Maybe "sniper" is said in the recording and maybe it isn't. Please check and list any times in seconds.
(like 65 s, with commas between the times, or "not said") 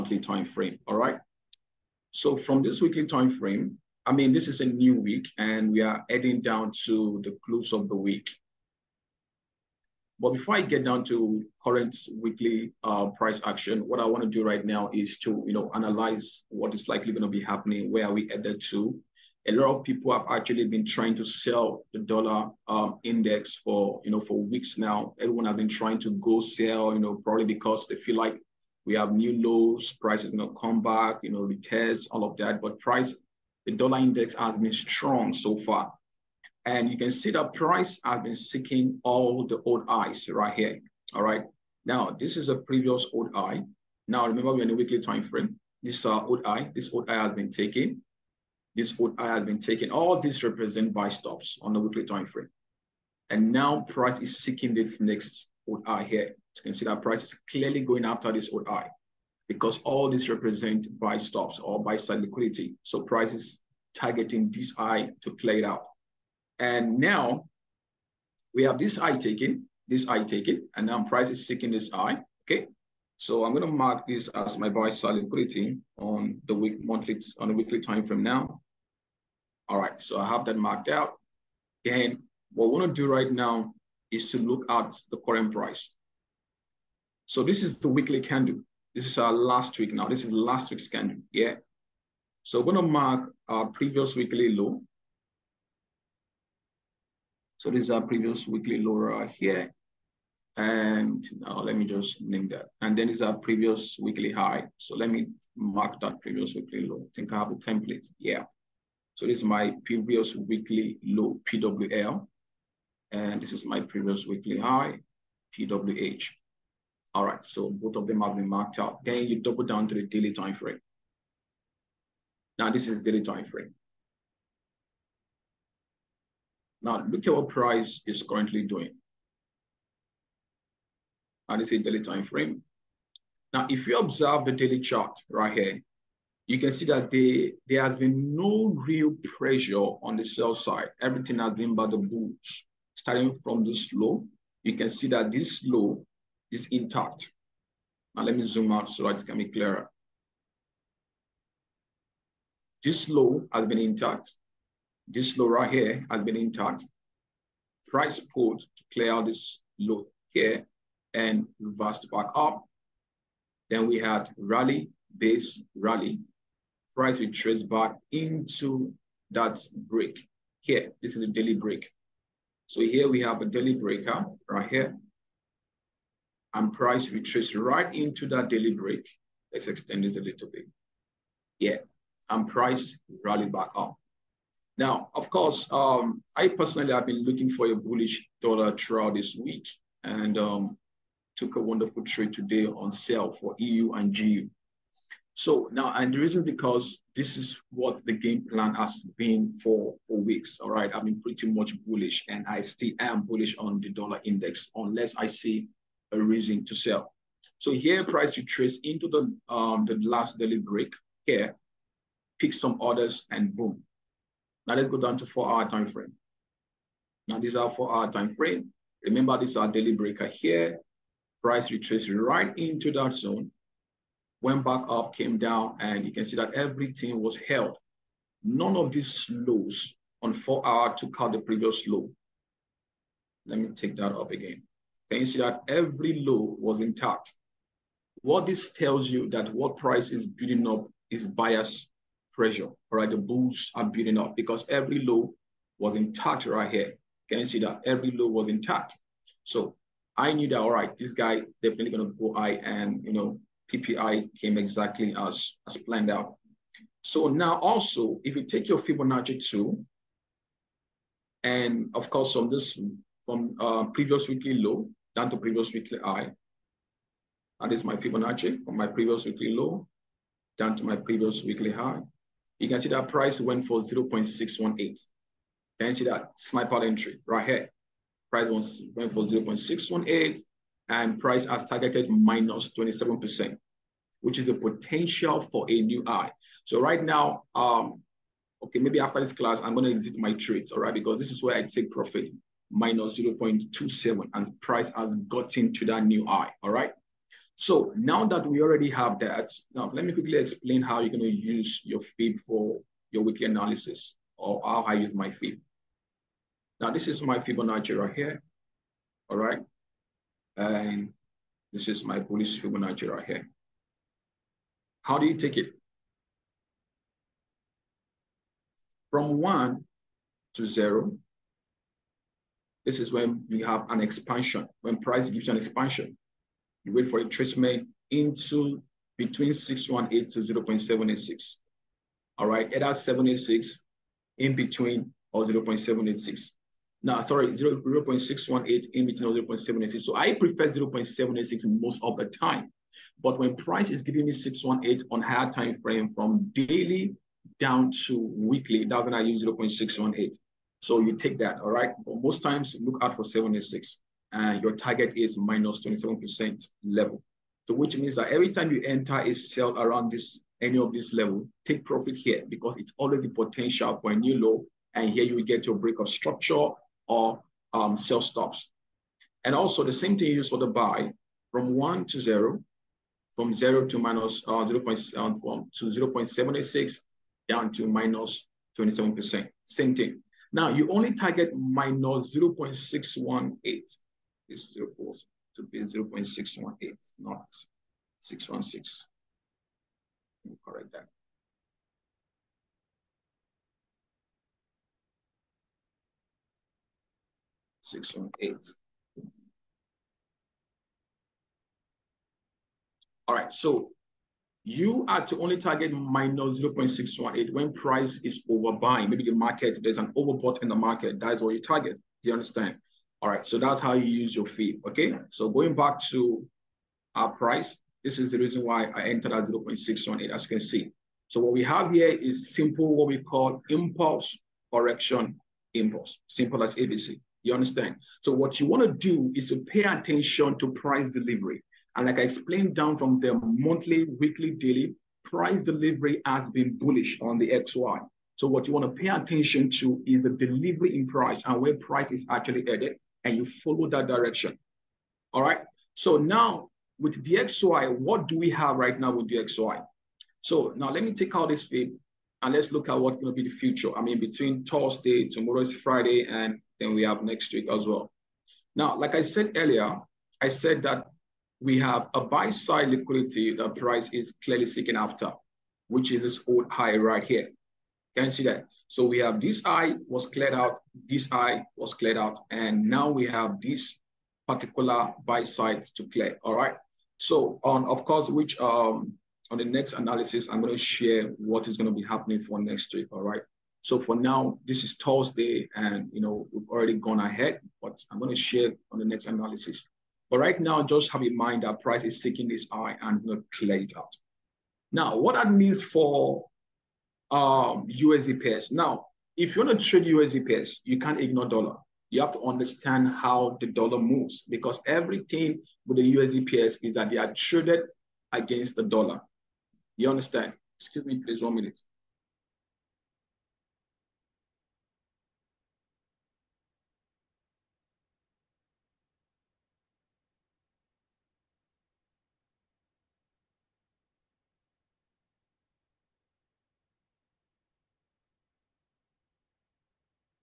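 276 s.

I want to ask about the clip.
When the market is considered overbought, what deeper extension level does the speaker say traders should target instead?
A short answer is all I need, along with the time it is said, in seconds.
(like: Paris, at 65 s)
-0.618, at 405 s.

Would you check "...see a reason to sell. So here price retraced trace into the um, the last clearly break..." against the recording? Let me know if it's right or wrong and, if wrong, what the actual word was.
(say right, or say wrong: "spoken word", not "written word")
wrong: "daily", not "clearly".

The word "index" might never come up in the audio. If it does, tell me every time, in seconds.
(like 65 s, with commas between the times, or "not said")
23 s, 33 s, 204 s.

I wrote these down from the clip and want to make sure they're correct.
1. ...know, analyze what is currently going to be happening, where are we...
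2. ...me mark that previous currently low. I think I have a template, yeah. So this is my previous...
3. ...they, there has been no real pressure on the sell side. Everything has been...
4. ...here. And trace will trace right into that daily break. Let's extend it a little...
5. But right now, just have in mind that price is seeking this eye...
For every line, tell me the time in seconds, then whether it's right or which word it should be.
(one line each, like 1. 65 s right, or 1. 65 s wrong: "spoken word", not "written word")
1. 15 s wrong: "likely", not "currently"
2. 105 s wrong: "weekly", not "currently"
3. 137 s right
4. 174 s wrong: "price", not "trace"
5. 490 s right.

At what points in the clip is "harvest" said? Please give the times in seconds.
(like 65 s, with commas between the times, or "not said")
not said.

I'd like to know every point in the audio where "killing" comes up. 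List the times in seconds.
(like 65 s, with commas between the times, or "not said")
not said.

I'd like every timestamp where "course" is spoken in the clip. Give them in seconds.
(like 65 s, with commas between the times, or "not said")
185 s, 262 s, 478 s.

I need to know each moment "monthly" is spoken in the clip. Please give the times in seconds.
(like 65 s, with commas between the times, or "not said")
76 s, 433 s.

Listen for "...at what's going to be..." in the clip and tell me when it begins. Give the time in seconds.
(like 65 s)
452 s.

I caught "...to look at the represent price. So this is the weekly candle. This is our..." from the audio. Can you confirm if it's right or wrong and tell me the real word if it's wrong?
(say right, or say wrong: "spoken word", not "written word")
wrong: "current", not "represent".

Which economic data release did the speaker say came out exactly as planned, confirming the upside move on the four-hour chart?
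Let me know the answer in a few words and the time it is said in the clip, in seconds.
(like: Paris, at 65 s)
PPI, at 253 s.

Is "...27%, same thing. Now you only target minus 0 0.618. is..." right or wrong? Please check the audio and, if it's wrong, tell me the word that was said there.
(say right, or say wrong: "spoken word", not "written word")
right.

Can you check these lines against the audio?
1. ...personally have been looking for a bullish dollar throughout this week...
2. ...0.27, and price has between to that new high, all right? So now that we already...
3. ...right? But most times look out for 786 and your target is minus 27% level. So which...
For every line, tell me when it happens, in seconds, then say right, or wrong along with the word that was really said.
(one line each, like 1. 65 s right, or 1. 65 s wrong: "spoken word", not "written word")
1. 186 s right
2. 293 s wrong: "gotten", not "between"
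3. 351 s right.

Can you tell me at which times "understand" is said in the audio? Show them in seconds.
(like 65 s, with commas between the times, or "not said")
412 s, 427 s, 502 s, 510 s.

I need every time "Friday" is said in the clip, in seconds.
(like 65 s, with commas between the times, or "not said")
455 s.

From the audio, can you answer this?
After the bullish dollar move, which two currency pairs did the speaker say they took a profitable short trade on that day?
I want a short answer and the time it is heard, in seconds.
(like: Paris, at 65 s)
EU and GU, at 193 s.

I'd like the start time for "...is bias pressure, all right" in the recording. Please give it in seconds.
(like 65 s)
241 s.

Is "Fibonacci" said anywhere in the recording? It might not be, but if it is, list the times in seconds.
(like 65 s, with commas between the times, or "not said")
258 s, 267 s, 307 s, 312 s.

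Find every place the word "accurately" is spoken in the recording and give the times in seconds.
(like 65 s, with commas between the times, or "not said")
not said.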